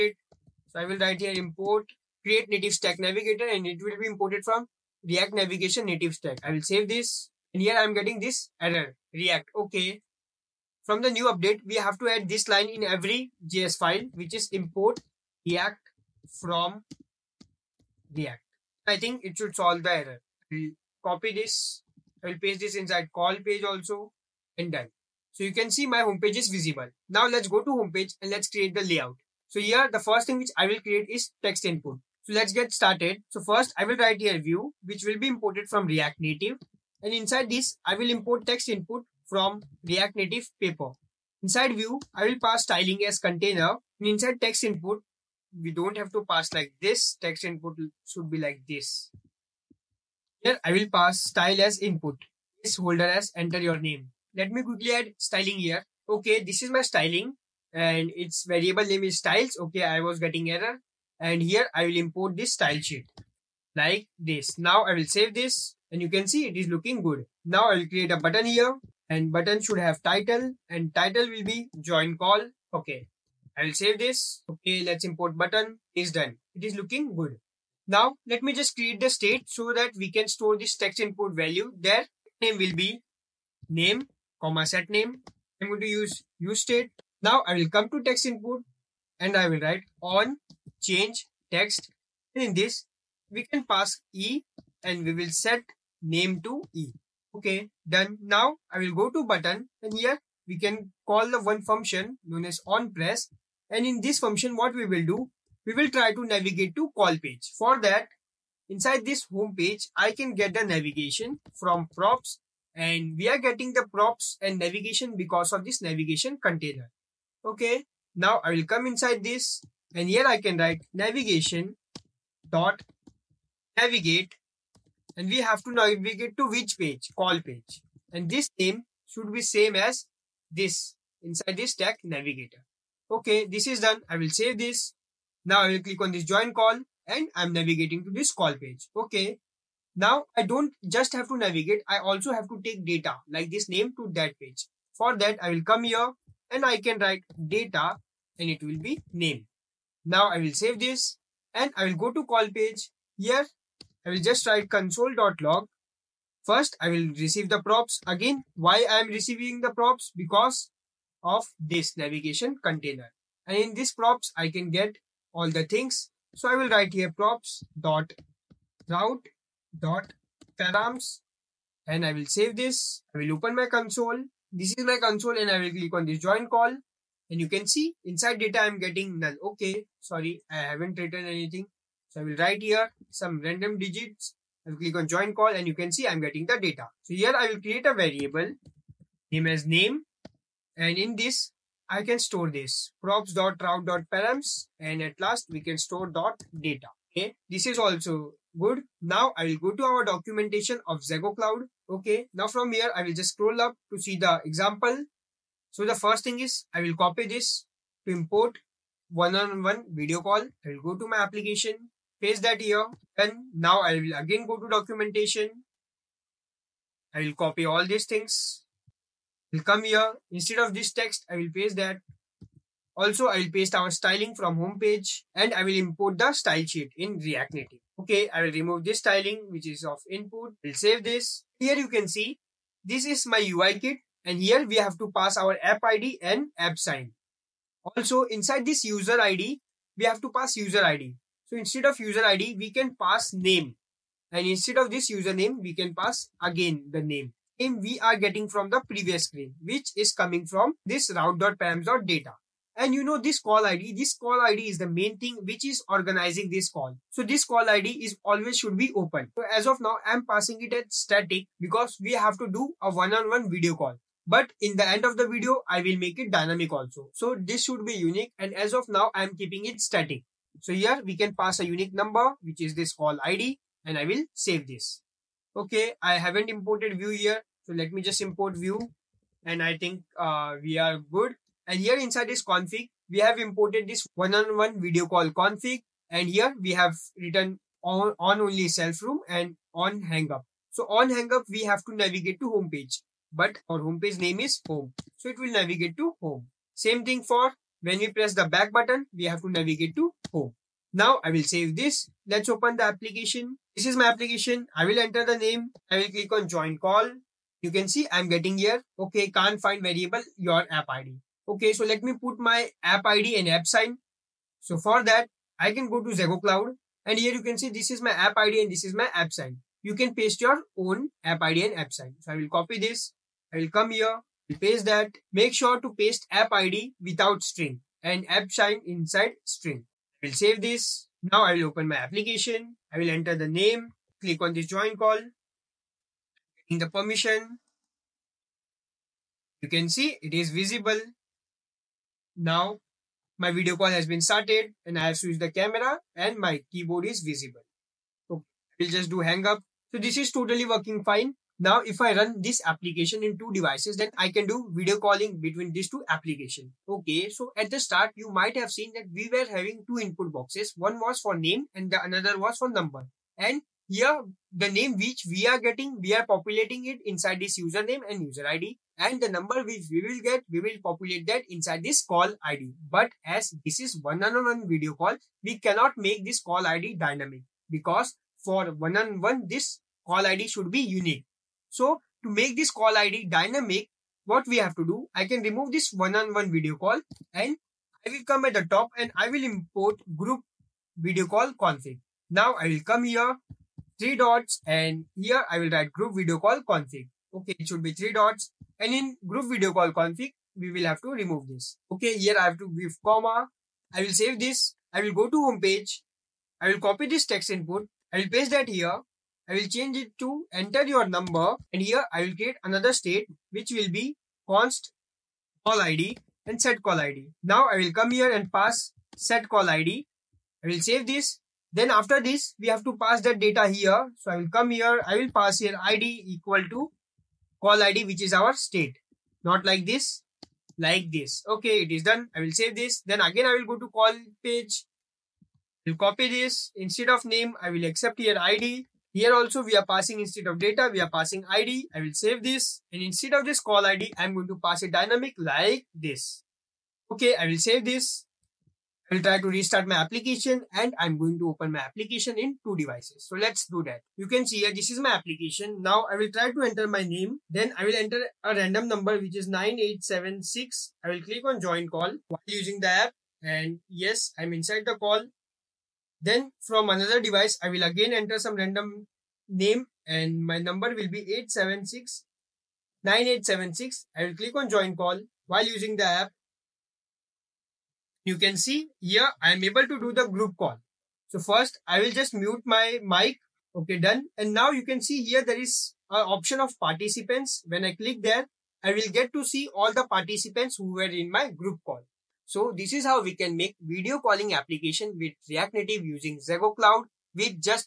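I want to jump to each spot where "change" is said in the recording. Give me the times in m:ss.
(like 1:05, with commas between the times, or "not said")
1:30, 6:49.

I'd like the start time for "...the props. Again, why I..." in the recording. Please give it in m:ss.
2:37.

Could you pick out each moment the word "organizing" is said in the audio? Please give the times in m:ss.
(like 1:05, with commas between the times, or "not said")
4:15.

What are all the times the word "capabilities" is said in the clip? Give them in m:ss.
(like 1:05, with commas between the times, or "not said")
not said.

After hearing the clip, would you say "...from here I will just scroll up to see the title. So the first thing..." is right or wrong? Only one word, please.
wrong.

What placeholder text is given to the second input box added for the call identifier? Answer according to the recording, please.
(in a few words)
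enter your number.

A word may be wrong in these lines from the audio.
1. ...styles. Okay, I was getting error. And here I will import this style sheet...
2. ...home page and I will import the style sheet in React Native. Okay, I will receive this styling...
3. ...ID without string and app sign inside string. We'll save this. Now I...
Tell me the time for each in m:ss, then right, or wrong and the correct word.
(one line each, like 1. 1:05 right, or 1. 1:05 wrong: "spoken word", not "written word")
1. 0:59 right
2. 3:44 wrong: "remove", not "receive"
3. 5:26 right.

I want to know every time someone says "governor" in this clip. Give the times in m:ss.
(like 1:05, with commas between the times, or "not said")
not said.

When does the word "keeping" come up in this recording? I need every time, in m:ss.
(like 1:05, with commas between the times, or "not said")
4:29.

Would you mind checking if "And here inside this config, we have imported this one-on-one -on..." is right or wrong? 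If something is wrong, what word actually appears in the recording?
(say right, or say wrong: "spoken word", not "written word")
right.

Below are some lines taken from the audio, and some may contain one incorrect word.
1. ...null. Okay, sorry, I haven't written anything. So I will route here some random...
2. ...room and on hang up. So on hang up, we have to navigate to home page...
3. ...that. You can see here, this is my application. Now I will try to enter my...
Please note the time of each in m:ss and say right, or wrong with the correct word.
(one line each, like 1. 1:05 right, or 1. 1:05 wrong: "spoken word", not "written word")
1. 2:59 wrong: "write", not "route"
2. 4:49 right
3. 7:33 right.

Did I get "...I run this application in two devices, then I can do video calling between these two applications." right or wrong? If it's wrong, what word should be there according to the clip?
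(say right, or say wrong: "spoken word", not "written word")
right.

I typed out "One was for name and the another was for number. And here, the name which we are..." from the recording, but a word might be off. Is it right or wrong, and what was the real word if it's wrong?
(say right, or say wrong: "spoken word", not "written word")
right.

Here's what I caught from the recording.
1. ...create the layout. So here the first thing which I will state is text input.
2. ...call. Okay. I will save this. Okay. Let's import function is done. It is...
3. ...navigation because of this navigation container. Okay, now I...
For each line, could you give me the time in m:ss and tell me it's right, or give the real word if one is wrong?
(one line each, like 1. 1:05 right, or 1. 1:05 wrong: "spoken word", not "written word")
1. 0:28 wrong: "create", not "state"
2. 1:12 wrong: "button", not "function"
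3. 1:54 right.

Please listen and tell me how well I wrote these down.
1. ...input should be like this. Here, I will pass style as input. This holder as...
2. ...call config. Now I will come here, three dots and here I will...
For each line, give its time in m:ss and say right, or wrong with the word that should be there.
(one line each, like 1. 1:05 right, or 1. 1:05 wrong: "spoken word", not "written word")
1. 0:47 right
2. 6:31 right.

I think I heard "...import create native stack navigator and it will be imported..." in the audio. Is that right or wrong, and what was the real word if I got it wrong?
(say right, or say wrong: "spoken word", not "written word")
right.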